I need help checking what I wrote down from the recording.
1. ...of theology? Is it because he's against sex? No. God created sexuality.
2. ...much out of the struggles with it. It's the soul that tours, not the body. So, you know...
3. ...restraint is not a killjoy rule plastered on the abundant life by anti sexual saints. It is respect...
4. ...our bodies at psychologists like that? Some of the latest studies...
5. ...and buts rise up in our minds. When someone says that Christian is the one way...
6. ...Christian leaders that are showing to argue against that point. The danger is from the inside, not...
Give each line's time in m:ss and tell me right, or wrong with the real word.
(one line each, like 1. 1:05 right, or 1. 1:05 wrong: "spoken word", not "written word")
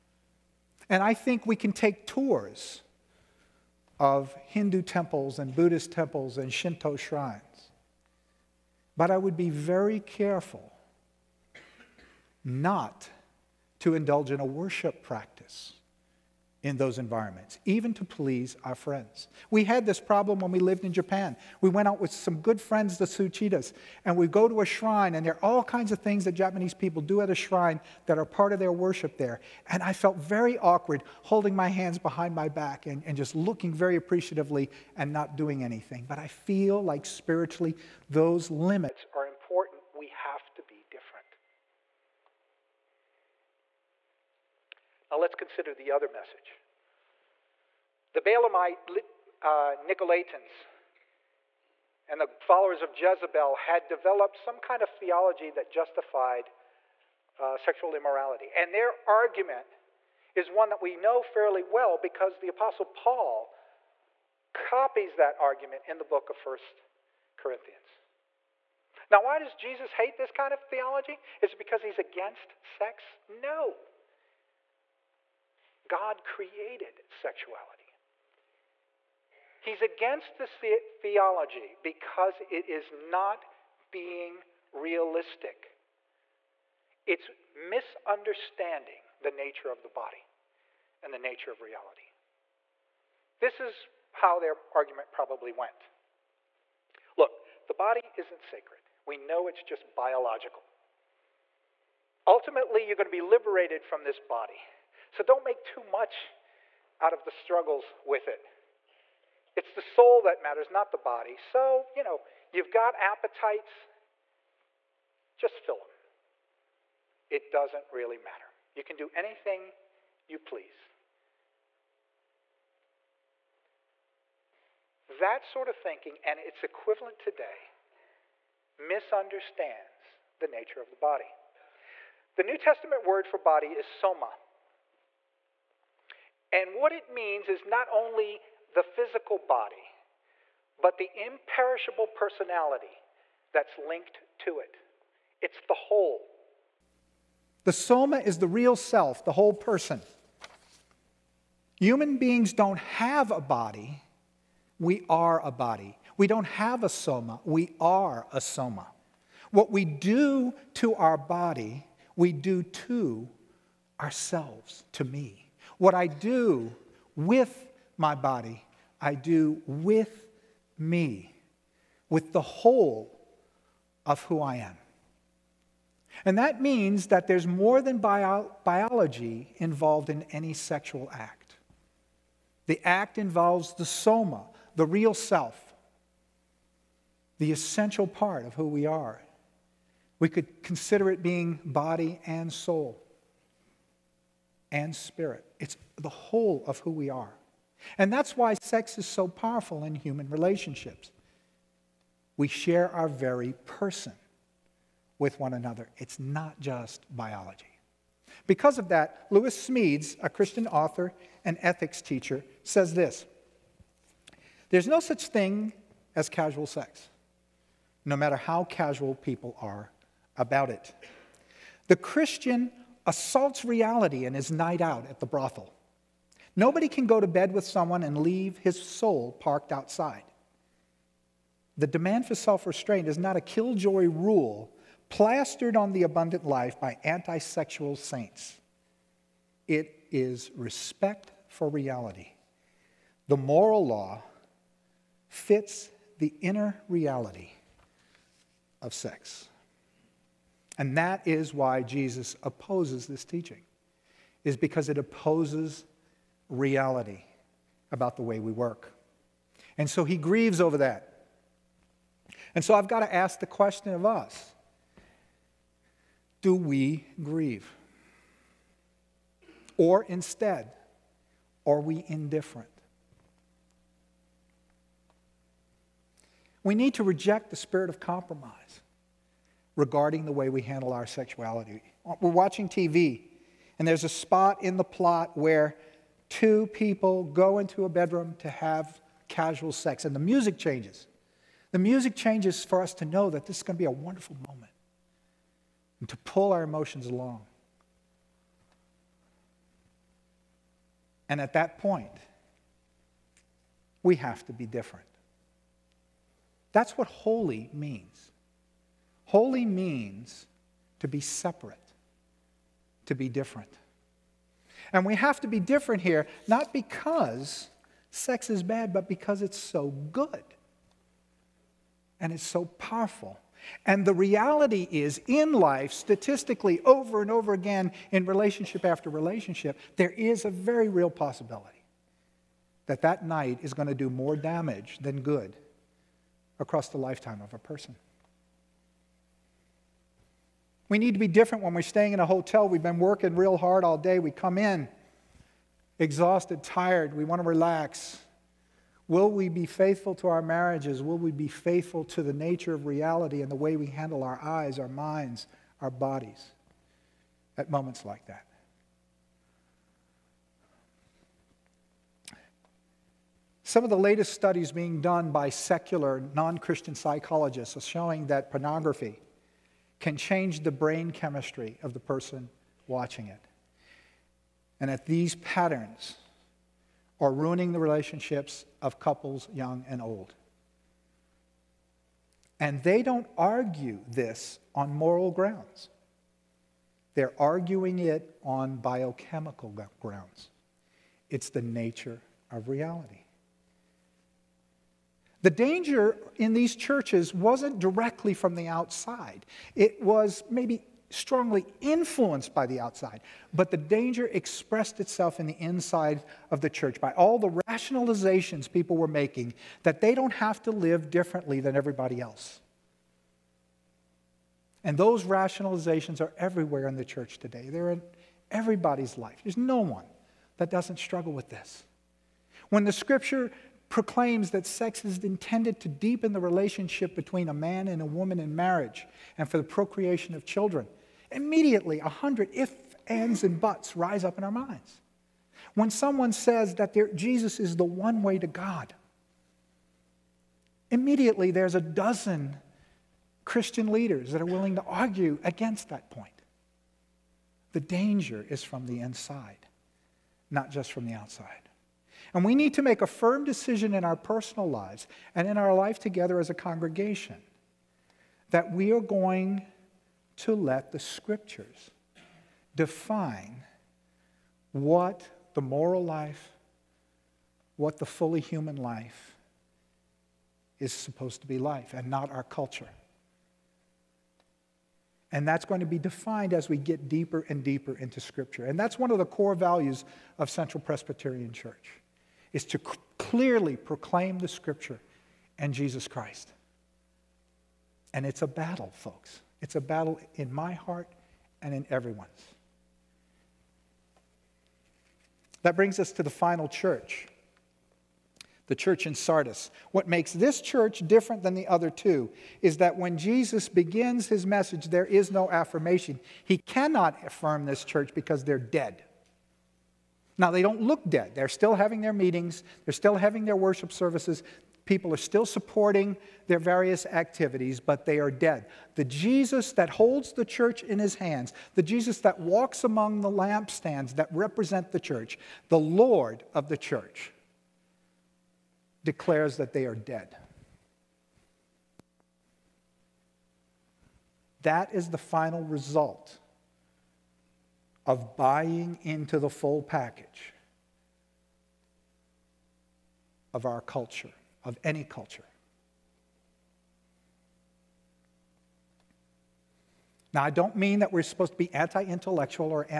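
1. 1:10 right
2. 1:45 wrong: "matters", not "tours"
3. 3:52 right
4. 5:55 wrong: "moments", not "psychologists"
5. 7:13 wrong: "Jesus", not "Christian"
6. 7:23 wrong: "willing", not "showing".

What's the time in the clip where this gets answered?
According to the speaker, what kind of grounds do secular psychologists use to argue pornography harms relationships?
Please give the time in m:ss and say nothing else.
6:28.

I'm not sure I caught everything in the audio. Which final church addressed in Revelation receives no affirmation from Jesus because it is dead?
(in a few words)
Sardis.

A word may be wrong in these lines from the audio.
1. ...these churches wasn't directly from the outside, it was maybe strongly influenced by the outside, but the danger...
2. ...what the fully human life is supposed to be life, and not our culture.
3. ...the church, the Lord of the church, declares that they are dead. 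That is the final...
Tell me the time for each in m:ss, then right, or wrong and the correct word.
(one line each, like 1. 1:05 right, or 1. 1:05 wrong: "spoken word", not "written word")
1. 6:36 right
2. 7:47 right
3. 8:44 right.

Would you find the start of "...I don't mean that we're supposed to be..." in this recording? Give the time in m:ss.
9:10.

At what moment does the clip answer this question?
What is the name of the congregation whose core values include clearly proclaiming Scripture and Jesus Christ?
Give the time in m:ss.
8:00.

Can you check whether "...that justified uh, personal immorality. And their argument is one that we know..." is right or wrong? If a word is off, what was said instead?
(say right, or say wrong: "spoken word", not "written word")
wrong: "sexual", not "personal".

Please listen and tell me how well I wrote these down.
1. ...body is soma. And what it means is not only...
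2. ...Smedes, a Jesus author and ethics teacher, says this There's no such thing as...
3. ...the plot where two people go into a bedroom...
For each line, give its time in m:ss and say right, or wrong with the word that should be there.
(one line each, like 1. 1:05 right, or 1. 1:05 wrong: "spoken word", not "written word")
1. 2:13 right
2. 3:29 wrong: "Christian", not "Jesus"
3. 4:44 right.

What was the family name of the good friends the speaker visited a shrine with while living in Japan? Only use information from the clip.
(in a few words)
Suchitas.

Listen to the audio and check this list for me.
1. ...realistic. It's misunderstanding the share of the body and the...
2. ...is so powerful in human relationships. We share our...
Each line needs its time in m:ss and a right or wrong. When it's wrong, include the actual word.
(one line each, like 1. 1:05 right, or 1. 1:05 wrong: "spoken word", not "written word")
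1. 1:24 wrong: "nature", not "share"
2. 3:18 right.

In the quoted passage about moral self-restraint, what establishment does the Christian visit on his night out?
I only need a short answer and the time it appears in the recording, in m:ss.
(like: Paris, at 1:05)
the brothel, at 3:45.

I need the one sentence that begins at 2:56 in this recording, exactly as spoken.
And that means that there's more than bio- biology involved in any sexual act.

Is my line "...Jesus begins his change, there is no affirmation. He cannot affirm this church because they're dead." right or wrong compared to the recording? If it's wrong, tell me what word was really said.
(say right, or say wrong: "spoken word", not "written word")
wrong: "message", not "change".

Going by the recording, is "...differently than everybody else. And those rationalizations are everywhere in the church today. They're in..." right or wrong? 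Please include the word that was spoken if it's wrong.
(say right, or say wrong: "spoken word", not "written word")
right.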